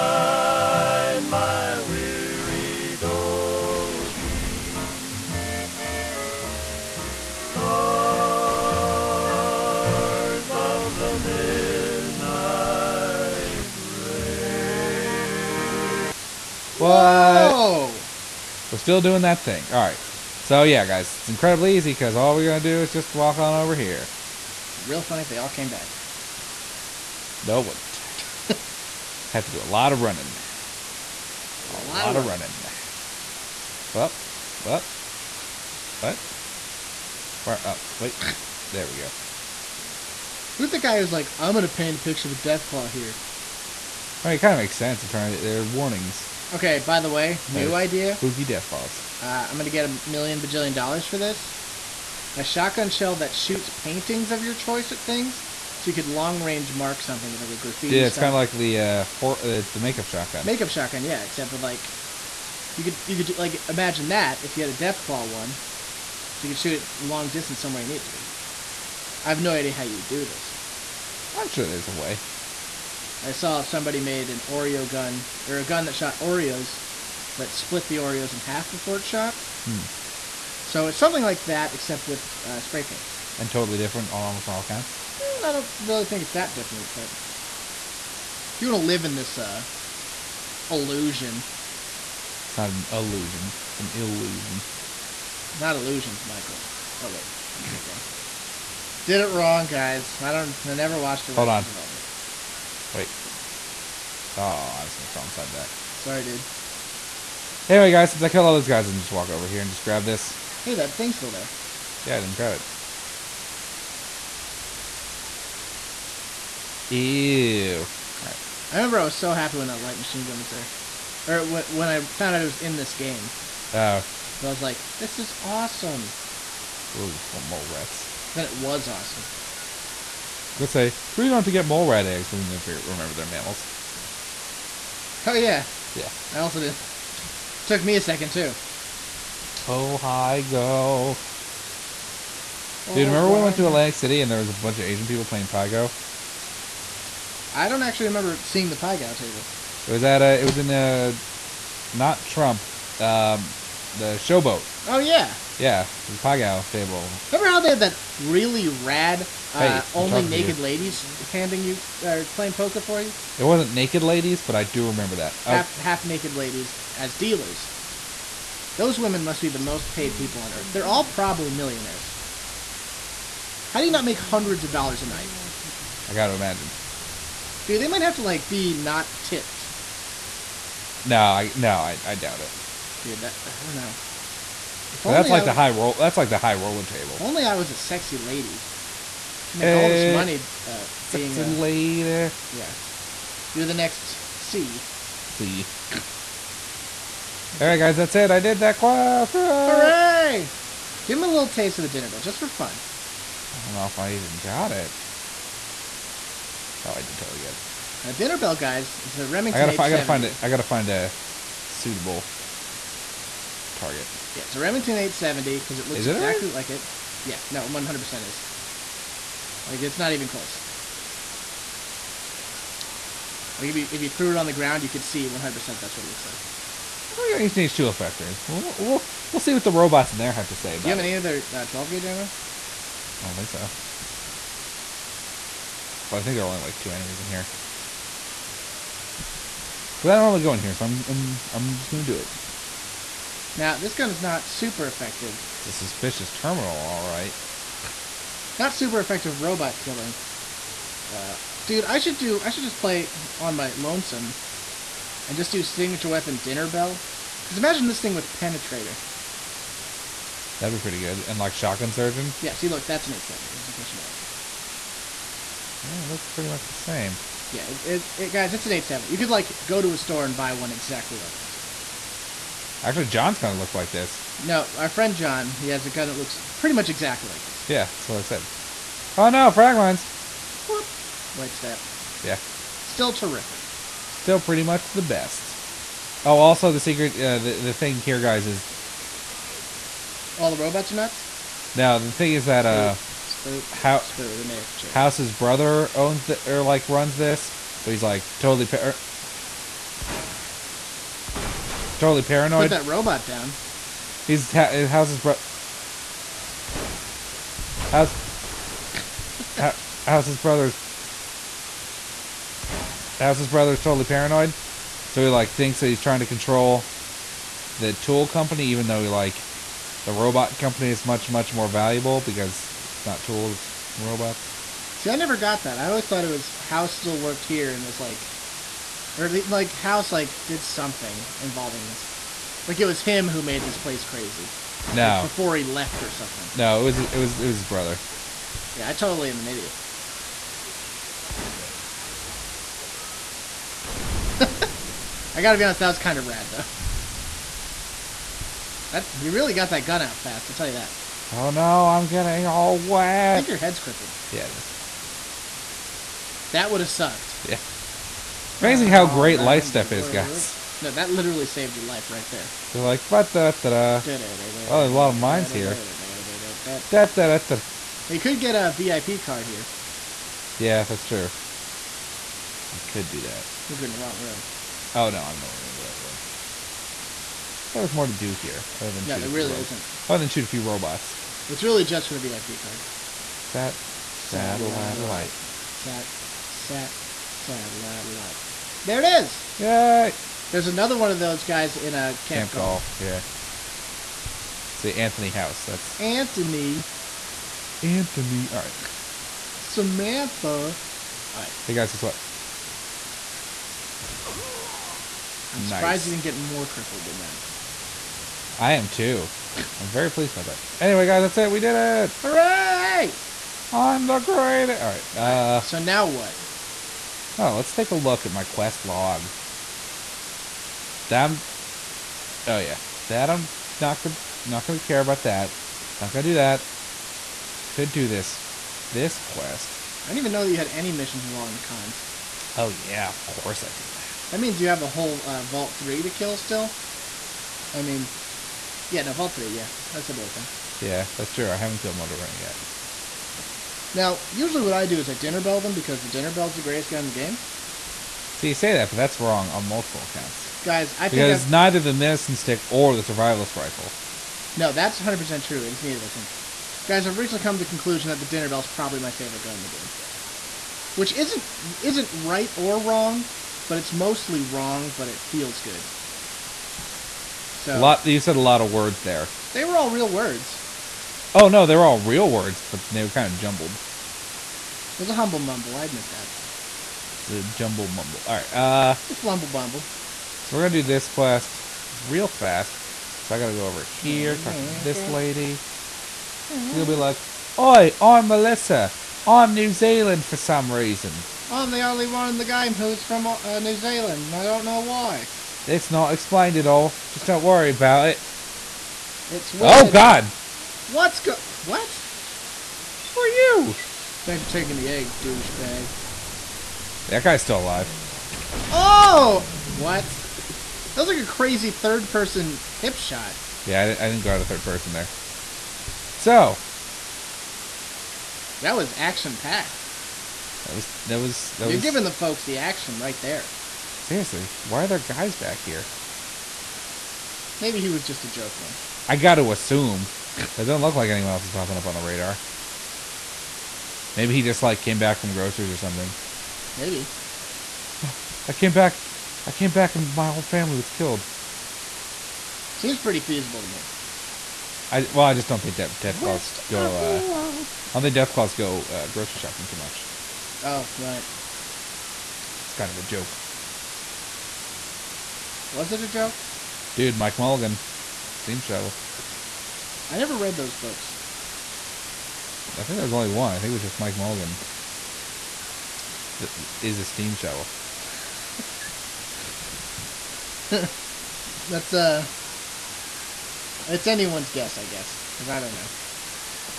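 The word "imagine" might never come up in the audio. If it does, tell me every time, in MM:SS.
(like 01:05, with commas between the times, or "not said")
01:03, 02:56, 04:17.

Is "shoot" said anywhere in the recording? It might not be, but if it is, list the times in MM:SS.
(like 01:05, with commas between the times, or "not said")
00:53, 01:06, 06:20.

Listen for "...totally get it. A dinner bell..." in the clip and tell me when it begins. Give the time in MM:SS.
03:27.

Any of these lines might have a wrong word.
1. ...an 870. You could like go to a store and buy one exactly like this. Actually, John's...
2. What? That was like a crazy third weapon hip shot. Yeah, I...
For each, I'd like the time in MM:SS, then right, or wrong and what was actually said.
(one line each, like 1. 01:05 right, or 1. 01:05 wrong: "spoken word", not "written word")
1. 04:28 right
2. 08:29 wrong: "person", not "weapon".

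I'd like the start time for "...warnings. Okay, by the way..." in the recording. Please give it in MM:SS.
00:45.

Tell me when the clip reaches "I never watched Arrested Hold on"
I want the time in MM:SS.
01:40.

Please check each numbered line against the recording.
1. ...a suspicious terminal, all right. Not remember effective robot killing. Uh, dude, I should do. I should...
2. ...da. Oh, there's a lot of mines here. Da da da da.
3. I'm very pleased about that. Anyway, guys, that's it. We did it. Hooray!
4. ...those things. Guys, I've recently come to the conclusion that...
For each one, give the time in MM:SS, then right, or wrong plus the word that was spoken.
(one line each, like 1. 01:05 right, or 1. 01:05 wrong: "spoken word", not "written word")
1. 04:05 wrong: "super", not "remember"
2. 06:04 right
3. 06:49 right
4. 07:36 right.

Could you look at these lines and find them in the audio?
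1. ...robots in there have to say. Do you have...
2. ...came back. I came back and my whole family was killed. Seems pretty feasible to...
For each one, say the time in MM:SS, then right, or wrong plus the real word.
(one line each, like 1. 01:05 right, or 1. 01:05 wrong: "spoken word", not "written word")
1. 03:49 right
2. 08:58 right.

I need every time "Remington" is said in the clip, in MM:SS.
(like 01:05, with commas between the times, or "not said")
03:29, 03:34.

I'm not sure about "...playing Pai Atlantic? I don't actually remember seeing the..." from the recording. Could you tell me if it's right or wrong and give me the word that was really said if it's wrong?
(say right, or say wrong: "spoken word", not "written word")
wrong: "Gow", not "Atlantic".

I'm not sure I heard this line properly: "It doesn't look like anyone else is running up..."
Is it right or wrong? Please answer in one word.
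wrong.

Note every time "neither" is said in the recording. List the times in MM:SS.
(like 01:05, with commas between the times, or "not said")
07:31, 07:35.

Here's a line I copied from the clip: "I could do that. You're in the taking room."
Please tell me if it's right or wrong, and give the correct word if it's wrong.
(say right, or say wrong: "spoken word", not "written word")
wrong: "wrong", not "taking".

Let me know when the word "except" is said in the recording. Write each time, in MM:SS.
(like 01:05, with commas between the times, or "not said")
01:01, 01:21.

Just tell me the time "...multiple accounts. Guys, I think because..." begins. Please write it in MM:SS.
07:29.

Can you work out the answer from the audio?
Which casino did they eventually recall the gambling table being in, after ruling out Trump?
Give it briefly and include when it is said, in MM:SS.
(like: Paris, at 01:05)
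the Showboat, at 02:33.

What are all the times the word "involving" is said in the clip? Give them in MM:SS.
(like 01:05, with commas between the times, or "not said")
05:31, 07:11.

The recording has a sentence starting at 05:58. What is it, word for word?
It's amazing how great Lightstep is, guys.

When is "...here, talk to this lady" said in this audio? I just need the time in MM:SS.
08:03.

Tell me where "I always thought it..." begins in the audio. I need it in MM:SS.
05:25.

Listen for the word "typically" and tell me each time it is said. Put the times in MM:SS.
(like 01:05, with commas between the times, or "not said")
not said.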